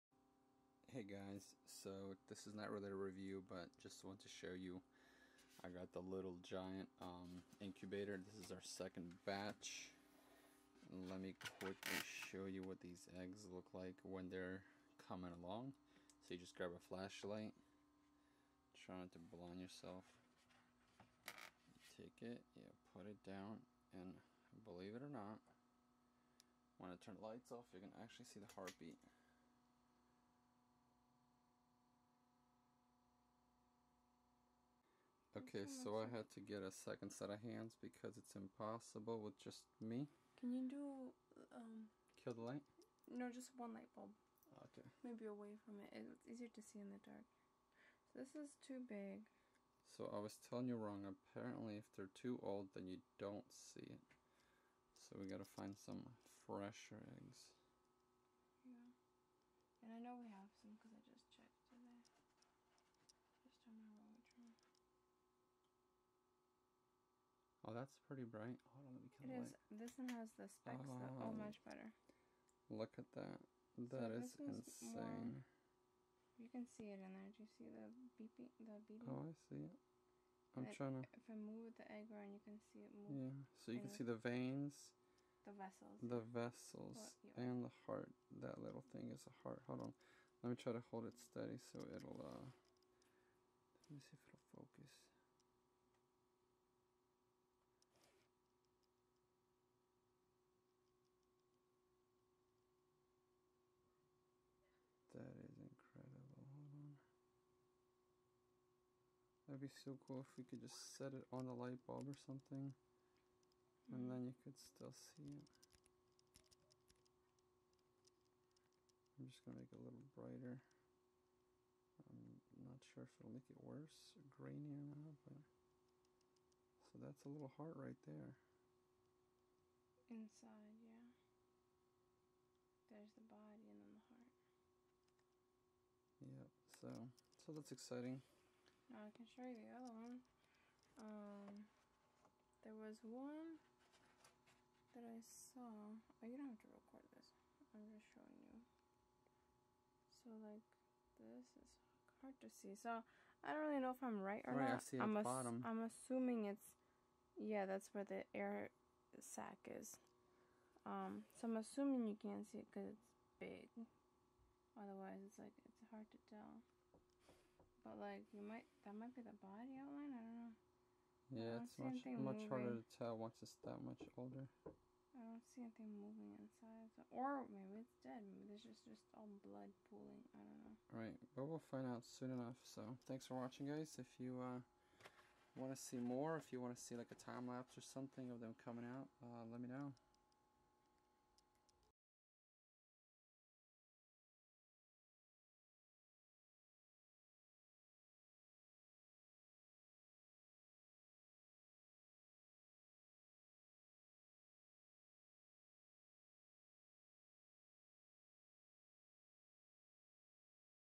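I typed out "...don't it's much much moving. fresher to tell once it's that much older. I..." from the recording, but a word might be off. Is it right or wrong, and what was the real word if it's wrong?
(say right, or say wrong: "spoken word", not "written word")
wrong: "harder", not "fresher".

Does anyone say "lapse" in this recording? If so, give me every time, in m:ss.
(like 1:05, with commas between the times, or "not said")
3:07.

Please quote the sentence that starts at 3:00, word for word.
Right, but we'll find out soon enough.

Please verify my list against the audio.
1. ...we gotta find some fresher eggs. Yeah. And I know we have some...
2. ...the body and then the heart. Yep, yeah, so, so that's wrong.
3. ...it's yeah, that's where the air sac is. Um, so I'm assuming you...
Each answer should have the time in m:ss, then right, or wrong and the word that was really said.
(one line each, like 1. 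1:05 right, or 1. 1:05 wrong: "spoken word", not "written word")
1. 0:55 right
2. 2:13 wrong: "exciting", not "wrong"
3. 2:36 right.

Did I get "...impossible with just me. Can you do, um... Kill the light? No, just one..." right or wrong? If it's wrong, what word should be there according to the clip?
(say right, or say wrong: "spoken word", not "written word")
right.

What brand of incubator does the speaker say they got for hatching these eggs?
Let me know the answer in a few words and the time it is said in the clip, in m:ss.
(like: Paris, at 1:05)
Little Giant, at 0:06.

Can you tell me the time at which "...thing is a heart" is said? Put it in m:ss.
1:28.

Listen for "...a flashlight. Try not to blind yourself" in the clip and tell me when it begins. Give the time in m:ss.
0:16.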